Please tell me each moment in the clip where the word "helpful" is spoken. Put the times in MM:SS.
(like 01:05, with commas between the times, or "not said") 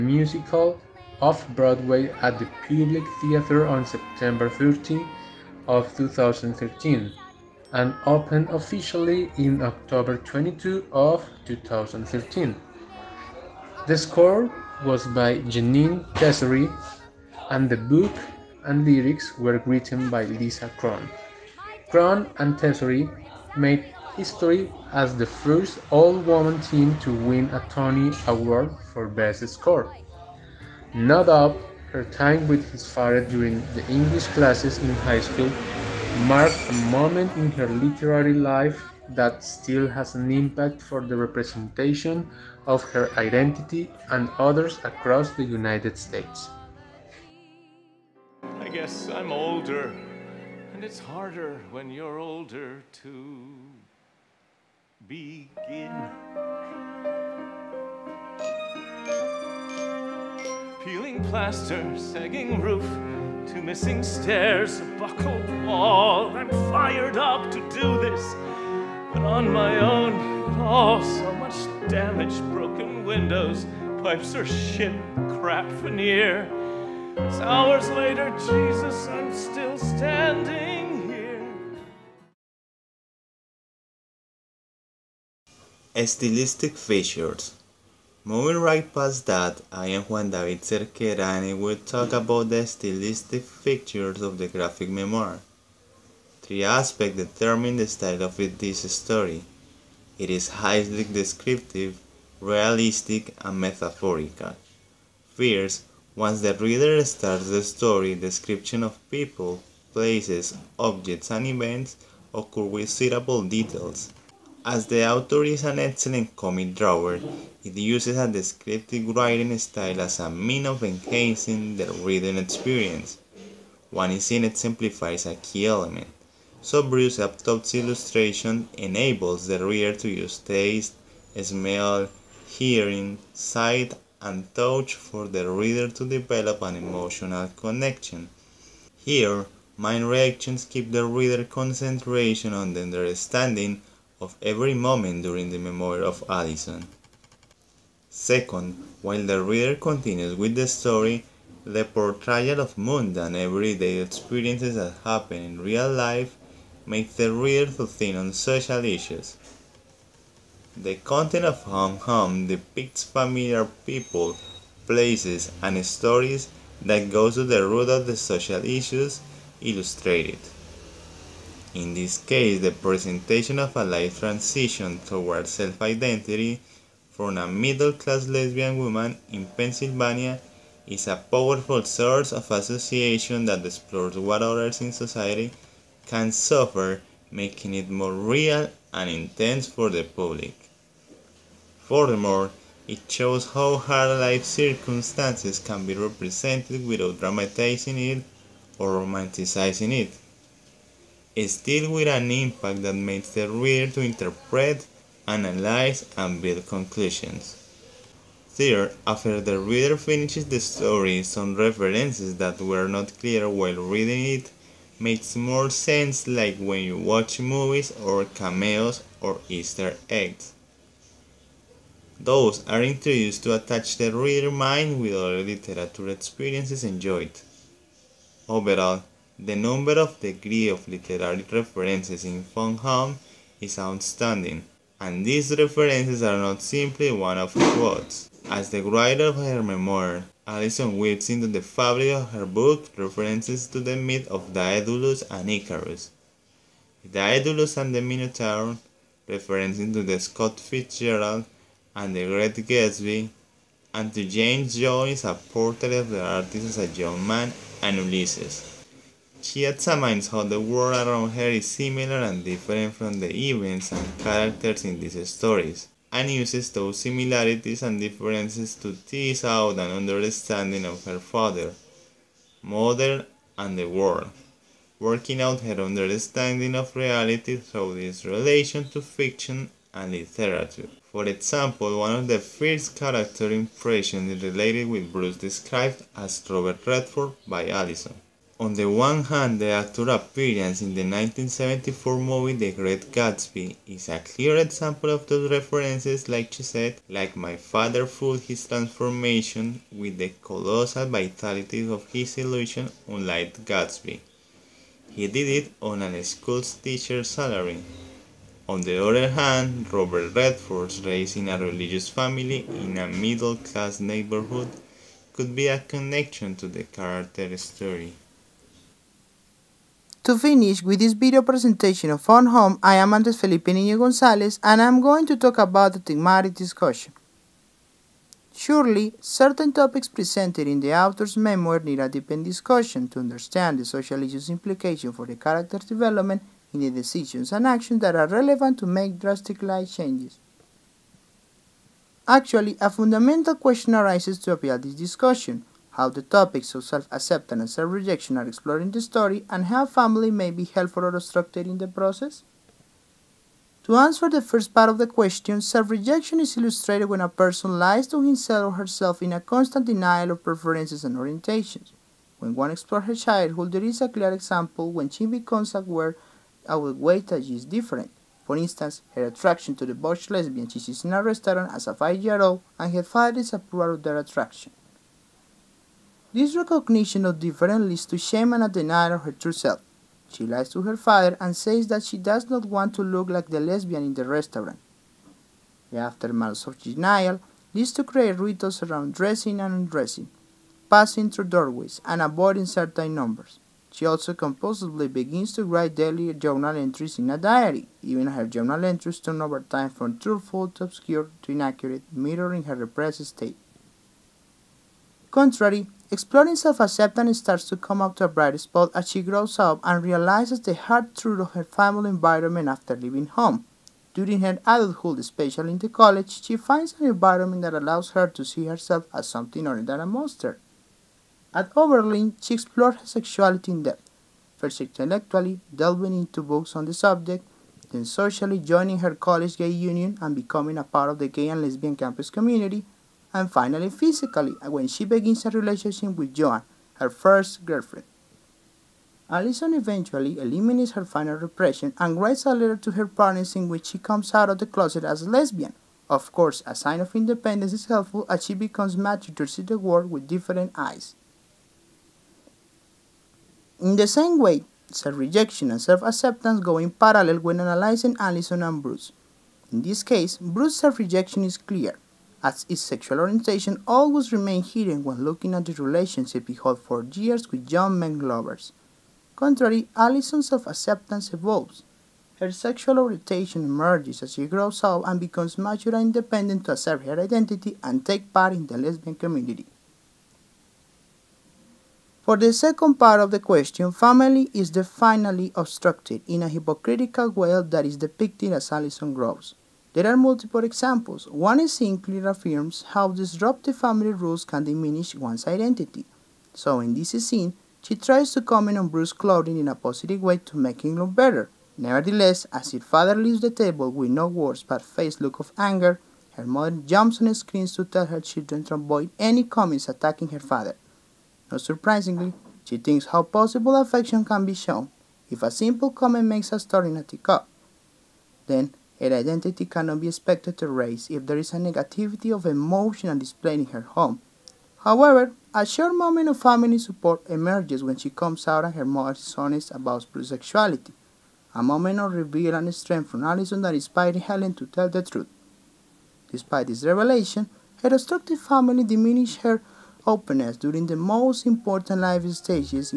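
05:50, 07:27.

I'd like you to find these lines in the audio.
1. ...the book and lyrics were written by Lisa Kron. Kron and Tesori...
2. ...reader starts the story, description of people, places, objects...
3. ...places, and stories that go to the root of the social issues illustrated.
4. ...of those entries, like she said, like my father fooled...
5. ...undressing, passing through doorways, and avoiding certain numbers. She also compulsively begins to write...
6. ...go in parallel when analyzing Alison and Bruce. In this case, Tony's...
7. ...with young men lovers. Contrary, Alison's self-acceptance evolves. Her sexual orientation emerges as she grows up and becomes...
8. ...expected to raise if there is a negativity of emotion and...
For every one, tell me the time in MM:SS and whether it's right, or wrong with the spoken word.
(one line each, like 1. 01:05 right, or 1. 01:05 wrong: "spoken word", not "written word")
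1. 00:17 right
2. 01:46 right
3. 02:44 right
4. 04:55 wrong: "references", not "entries"
5. 06:29 right
6. 07:36 wrong: "Bruce", not "Tony"
7. 07:47 right
8. 08:40 right.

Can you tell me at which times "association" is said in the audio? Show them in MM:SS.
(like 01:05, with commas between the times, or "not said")
03:02.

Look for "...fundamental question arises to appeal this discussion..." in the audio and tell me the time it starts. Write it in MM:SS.
05:42.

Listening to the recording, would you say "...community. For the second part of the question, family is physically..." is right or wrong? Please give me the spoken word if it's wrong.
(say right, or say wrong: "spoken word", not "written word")
wrong: "definitely", not "physically".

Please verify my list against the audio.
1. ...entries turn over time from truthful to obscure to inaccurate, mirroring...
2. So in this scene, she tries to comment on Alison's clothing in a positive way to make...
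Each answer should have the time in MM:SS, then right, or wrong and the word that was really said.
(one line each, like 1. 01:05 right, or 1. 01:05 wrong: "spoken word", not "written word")
1. 06:38 right
2. 08:16 wrong: "Bruce", not "Alison".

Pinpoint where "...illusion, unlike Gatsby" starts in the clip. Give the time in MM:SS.
05:02.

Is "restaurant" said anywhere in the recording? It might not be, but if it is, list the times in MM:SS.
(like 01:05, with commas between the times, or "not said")
06:11, 06:24.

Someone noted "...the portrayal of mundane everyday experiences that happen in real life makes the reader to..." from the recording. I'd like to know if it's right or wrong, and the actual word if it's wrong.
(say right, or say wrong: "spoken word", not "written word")
right.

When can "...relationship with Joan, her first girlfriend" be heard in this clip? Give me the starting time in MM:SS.
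07:15.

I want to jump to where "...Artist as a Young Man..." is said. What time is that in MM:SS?
04:16.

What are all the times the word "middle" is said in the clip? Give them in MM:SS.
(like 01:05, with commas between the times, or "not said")
02:57, 05:13.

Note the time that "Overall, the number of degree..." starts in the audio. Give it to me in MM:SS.
03:48.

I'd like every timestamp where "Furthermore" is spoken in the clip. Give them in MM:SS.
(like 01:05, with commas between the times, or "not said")
03:11.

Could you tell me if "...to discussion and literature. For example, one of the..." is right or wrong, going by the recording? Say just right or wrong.
wrong.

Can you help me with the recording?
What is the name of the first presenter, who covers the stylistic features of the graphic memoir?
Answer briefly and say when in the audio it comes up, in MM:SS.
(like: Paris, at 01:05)
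Juan David Cerquera, at 01:30.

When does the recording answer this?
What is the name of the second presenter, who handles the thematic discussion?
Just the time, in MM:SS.
05:23.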